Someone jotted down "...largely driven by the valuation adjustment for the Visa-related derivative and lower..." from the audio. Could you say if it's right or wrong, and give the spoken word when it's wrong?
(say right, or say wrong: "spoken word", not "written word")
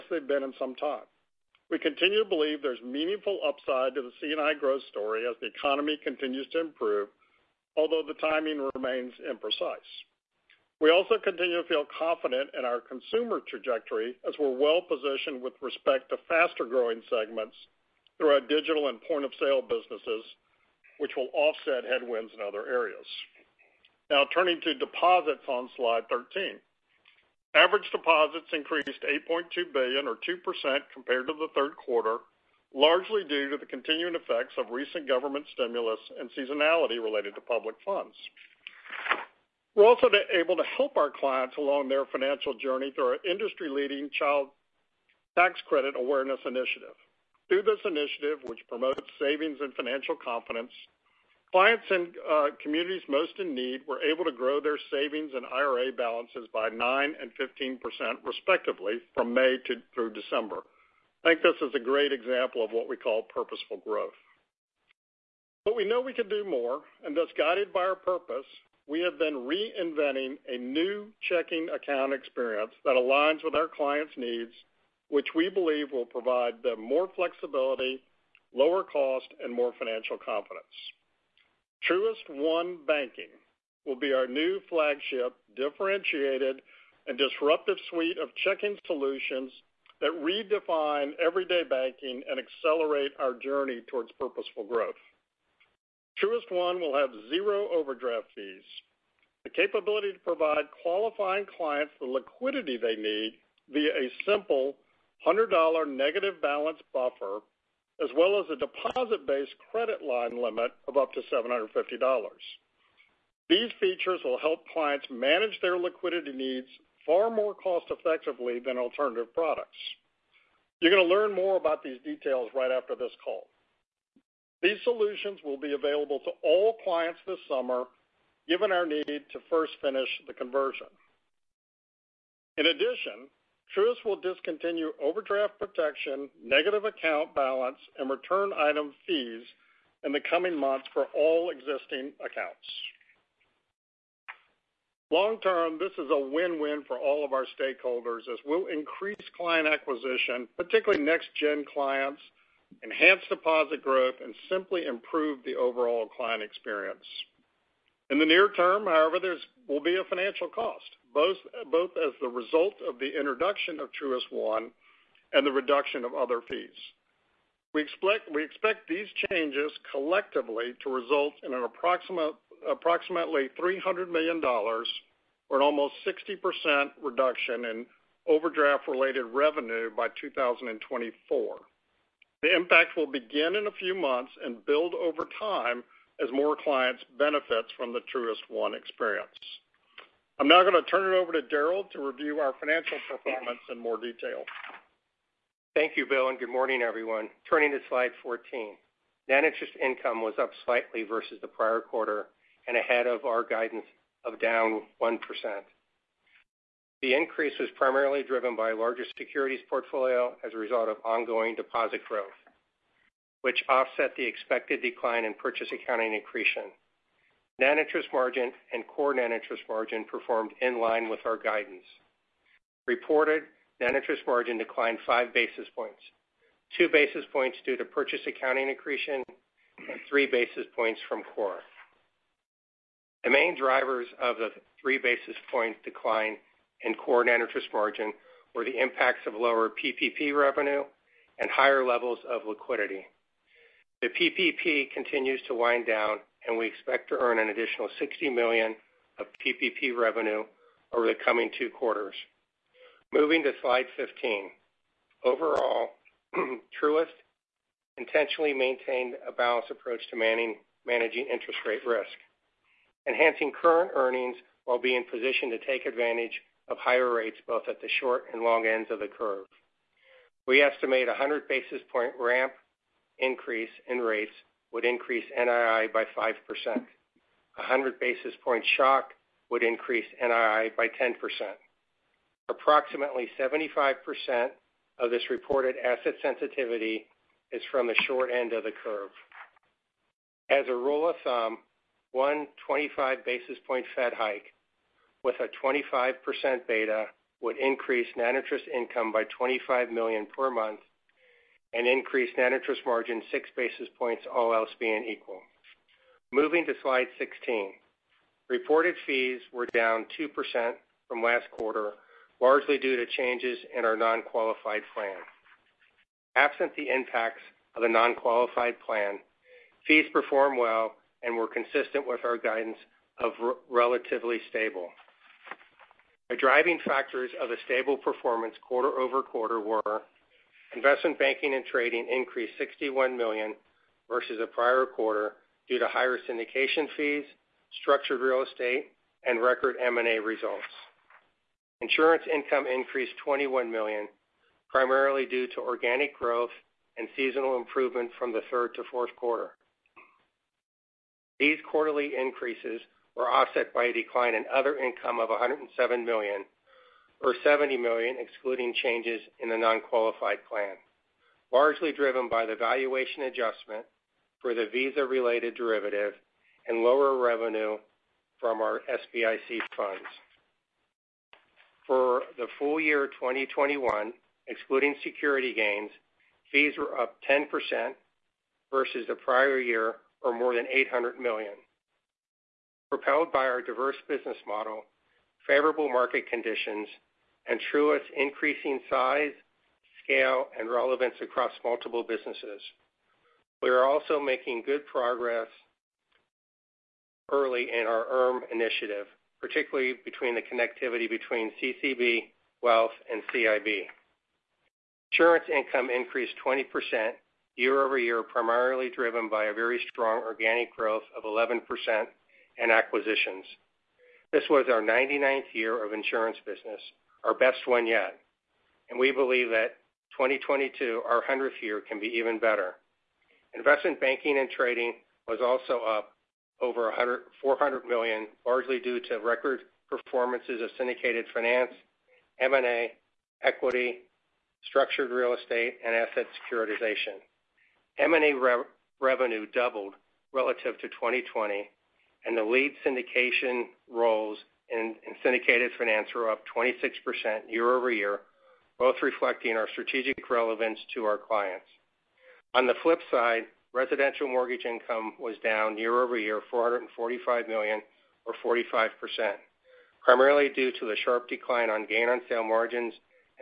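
right.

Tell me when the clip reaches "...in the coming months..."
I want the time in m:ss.
2:20.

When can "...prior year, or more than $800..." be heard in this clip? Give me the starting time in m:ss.
6:19.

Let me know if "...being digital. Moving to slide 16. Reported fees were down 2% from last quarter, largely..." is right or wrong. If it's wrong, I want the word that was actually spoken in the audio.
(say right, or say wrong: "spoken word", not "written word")
wrong: "equal", not "digital".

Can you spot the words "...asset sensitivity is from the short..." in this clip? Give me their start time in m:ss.
4:45.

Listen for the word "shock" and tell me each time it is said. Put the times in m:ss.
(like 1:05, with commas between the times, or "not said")
4:38.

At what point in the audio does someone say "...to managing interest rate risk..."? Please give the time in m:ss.
4:20.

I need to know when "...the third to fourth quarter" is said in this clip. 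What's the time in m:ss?
5:48.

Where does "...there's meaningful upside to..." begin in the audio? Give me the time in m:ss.
0:02.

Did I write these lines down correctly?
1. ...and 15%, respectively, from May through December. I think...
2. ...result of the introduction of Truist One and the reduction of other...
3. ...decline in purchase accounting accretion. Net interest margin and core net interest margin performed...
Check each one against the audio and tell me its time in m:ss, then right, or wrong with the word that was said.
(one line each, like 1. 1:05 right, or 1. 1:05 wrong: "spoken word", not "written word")
1. 0:57 right
2. 2:42 right
3. 3:34 right.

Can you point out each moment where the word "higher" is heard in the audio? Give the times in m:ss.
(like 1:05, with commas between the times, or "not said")
4:01, 4:26, 5:35.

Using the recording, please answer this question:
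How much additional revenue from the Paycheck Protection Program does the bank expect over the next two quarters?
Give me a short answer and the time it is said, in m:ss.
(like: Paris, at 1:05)
$60 million, at 4:07.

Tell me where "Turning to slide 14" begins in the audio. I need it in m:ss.
3:17.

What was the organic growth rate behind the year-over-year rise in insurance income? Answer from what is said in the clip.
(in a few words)
11%.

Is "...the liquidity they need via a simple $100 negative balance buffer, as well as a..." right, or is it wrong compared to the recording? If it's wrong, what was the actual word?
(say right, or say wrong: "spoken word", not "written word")
right.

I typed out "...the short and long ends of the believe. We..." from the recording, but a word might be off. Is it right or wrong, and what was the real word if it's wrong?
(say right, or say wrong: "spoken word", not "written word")
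wrong: "curve", not "believe".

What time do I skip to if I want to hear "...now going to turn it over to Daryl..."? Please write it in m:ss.
3:10.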